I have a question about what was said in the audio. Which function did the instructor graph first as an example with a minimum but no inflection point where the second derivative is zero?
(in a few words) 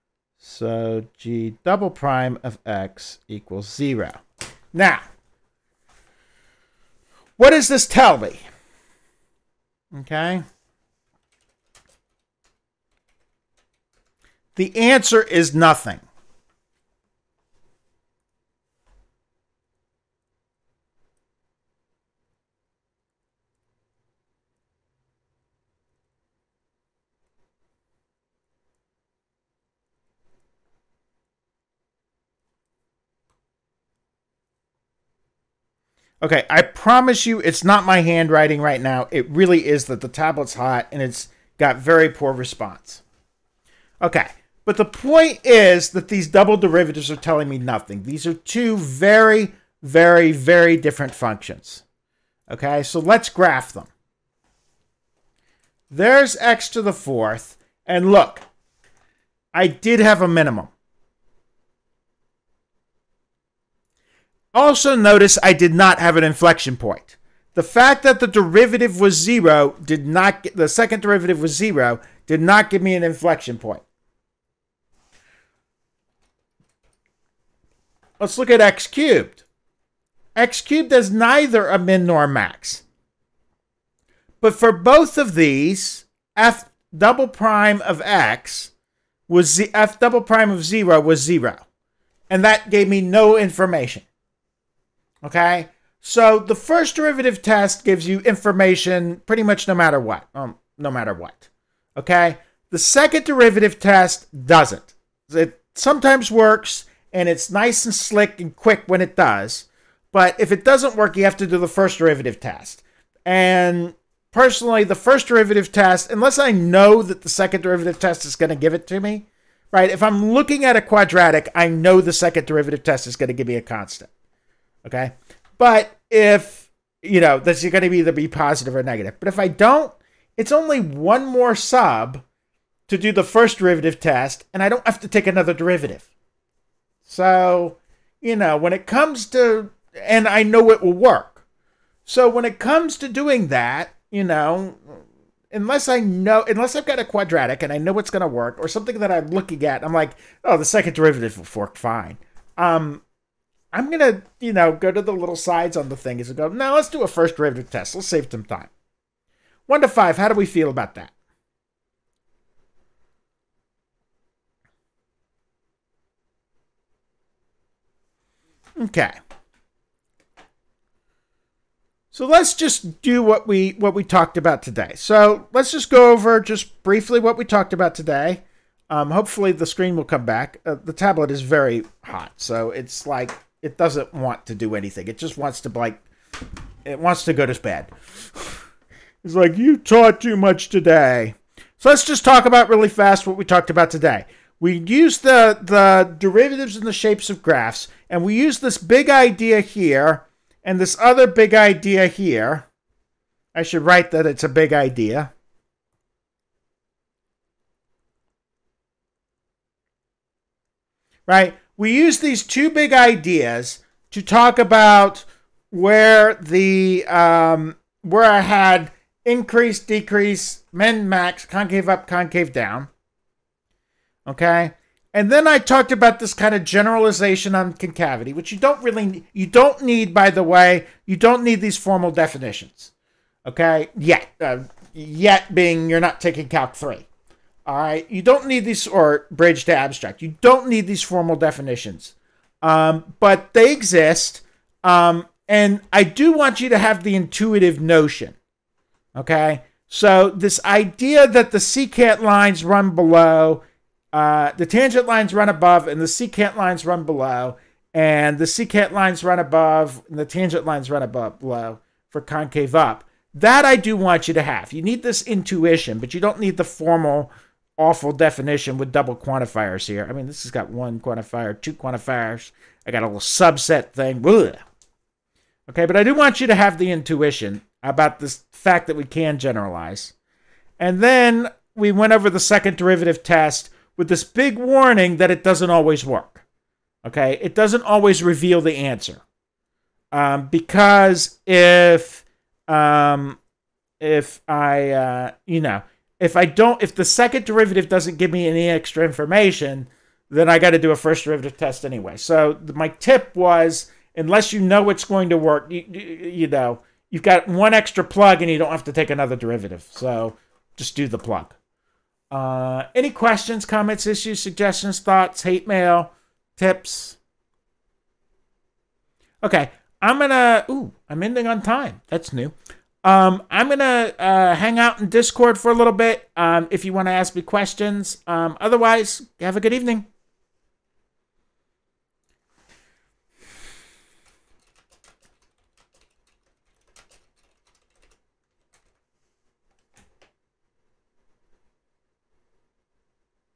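x to the fourth.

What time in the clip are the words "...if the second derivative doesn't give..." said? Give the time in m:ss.
4:56.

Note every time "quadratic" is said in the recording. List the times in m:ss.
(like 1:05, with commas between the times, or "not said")
2:00, 2:27.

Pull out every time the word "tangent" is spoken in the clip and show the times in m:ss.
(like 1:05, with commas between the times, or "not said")
4:14, 4:20.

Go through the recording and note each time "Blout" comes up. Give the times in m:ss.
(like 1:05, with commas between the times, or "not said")
not said.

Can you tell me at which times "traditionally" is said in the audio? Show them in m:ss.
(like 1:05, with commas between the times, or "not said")
not said.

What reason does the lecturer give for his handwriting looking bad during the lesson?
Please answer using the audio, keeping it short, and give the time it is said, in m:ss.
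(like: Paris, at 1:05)
the tablet's hot, at 0:40.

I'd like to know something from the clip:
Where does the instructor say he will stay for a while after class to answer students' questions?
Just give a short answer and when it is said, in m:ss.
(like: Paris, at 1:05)
Discord, at 5:25.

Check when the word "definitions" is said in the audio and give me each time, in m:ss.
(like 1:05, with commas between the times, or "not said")
3:52, 4:01, 4:28.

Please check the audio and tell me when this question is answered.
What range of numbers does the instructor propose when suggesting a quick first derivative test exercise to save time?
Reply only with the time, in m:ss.
2:39.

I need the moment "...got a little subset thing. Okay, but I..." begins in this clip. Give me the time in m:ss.
4:32.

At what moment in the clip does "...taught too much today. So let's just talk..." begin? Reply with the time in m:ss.
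3:09.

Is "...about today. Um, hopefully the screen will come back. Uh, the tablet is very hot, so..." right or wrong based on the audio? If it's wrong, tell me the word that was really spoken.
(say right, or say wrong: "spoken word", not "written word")
right.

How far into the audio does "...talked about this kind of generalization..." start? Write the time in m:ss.
3:45.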